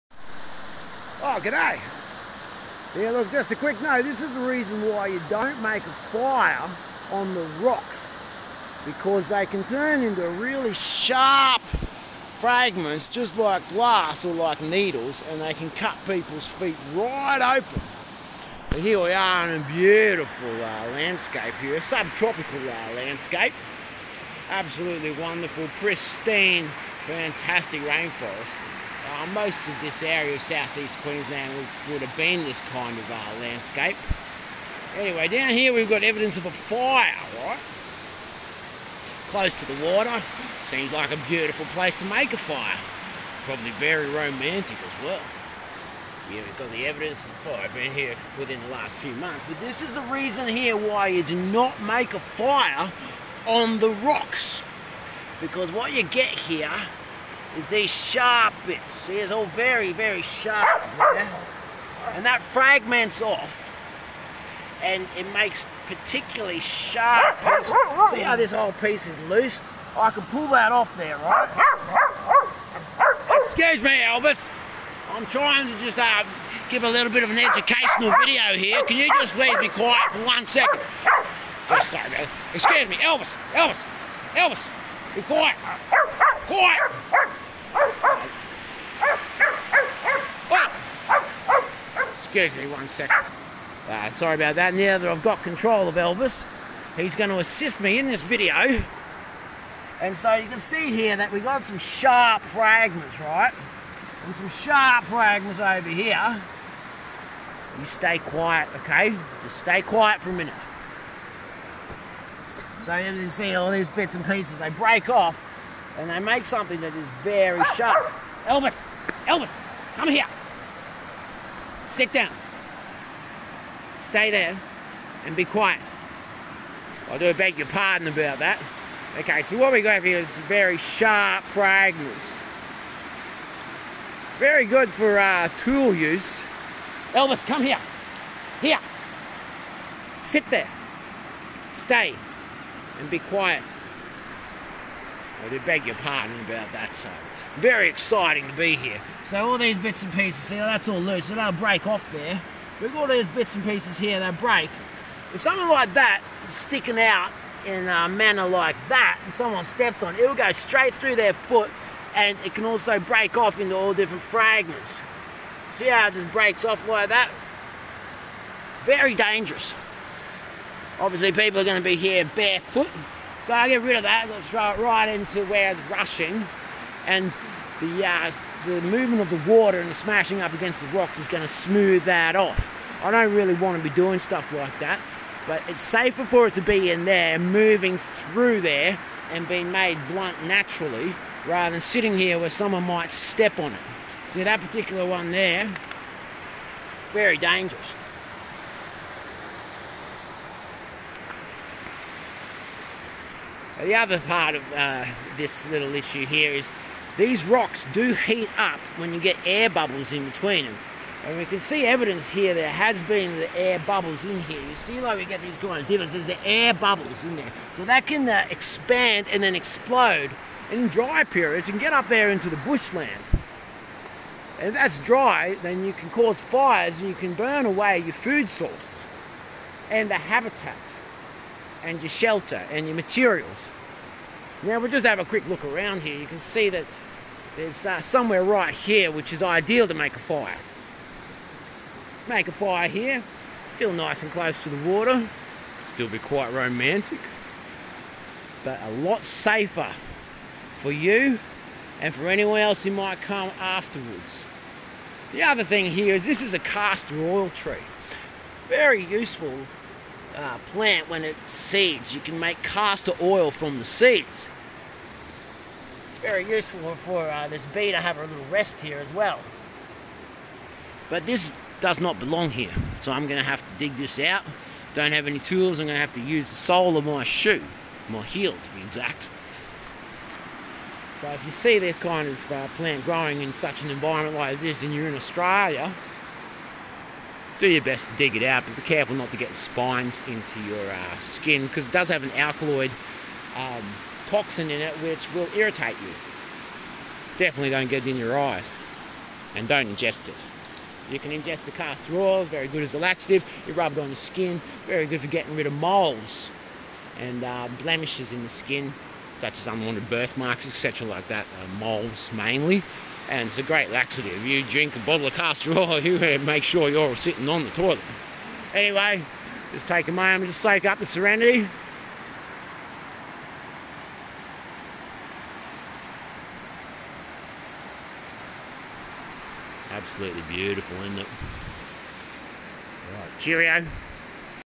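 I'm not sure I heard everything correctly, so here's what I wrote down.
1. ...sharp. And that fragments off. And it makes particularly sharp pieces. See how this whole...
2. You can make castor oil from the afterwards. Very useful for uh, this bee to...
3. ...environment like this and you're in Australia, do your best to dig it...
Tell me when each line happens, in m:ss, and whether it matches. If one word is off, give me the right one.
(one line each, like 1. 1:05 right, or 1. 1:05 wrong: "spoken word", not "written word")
1. 1:00 right
2. 4:22 wrong: "seeds", not "afterwards"
3. 4:43 right.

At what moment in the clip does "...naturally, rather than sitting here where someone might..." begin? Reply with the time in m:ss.
3:10.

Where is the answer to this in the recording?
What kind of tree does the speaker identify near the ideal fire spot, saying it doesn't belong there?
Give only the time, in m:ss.
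4:16.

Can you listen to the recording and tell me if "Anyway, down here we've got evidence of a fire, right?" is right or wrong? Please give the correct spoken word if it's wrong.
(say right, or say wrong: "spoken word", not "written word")
right.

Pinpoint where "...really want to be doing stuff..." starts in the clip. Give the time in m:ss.
3:03.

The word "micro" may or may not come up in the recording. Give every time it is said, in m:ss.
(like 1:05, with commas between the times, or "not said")
not said.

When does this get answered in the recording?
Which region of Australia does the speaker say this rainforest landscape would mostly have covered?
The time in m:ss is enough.
0:30.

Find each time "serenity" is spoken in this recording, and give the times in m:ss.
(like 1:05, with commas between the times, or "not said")
5:21.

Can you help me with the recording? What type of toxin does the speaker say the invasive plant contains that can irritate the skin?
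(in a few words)
alkaloid.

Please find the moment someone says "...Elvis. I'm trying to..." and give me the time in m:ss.
1:14.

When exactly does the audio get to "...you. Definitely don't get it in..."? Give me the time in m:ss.
4:56.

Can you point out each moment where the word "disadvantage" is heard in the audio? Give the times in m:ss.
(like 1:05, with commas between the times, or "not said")
not said.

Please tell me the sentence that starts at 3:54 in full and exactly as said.
Now we'll just have a quick look around here.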